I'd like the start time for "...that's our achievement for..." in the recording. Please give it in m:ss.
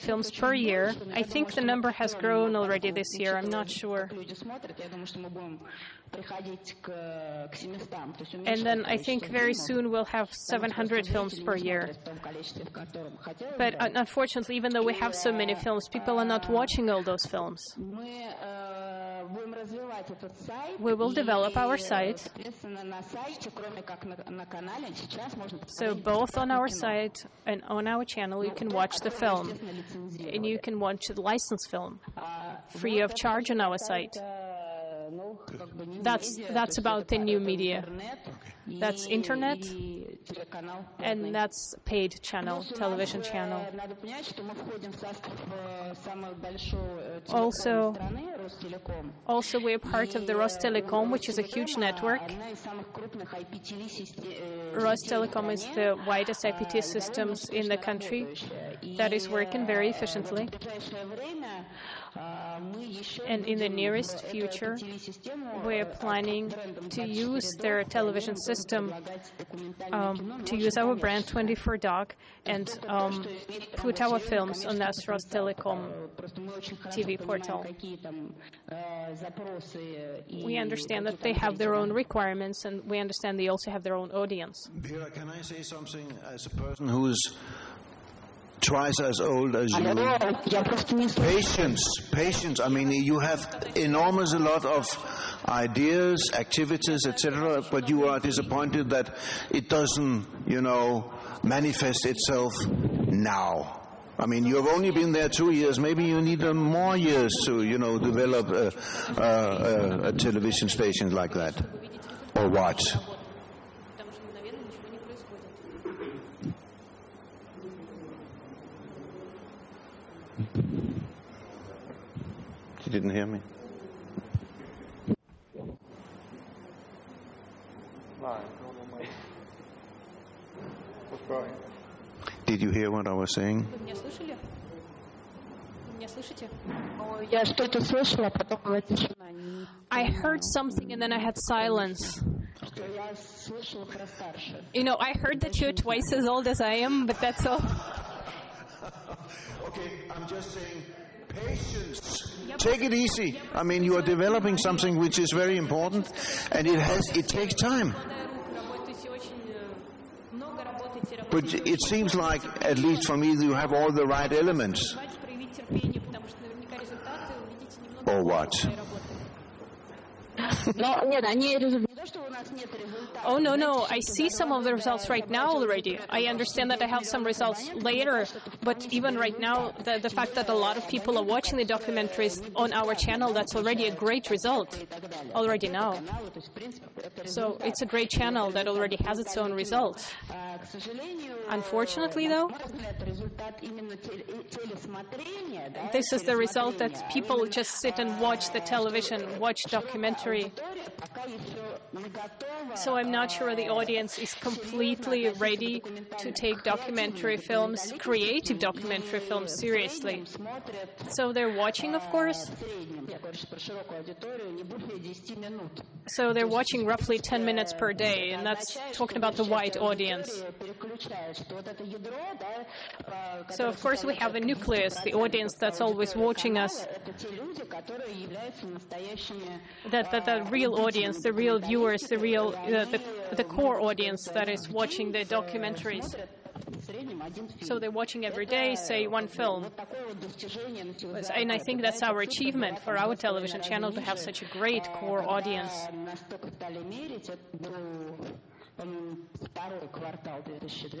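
4:01.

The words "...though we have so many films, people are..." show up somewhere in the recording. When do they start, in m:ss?
0:14.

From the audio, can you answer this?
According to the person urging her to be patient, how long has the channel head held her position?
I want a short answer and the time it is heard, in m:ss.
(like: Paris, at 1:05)
two years, at 1:45.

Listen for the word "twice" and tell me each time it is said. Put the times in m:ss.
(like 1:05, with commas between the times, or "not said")
1:28, 2:25.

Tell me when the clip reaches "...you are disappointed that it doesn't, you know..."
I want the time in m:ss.
1:37.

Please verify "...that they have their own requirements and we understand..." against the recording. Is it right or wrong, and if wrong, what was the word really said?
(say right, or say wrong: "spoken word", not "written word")
right.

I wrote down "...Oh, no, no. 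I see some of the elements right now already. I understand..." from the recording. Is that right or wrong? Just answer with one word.
wrong.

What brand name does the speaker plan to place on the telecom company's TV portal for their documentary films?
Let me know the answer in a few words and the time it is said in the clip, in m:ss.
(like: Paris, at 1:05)
24Doc, at 1:11.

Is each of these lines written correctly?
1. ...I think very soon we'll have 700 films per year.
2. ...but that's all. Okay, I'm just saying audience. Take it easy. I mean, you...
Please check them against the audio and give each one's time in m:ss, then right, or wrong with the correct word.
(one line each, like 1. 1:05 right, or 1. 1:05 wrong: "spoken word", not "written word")
1. 0:08 right
2. 2:27 wrong: "patience", not "audience".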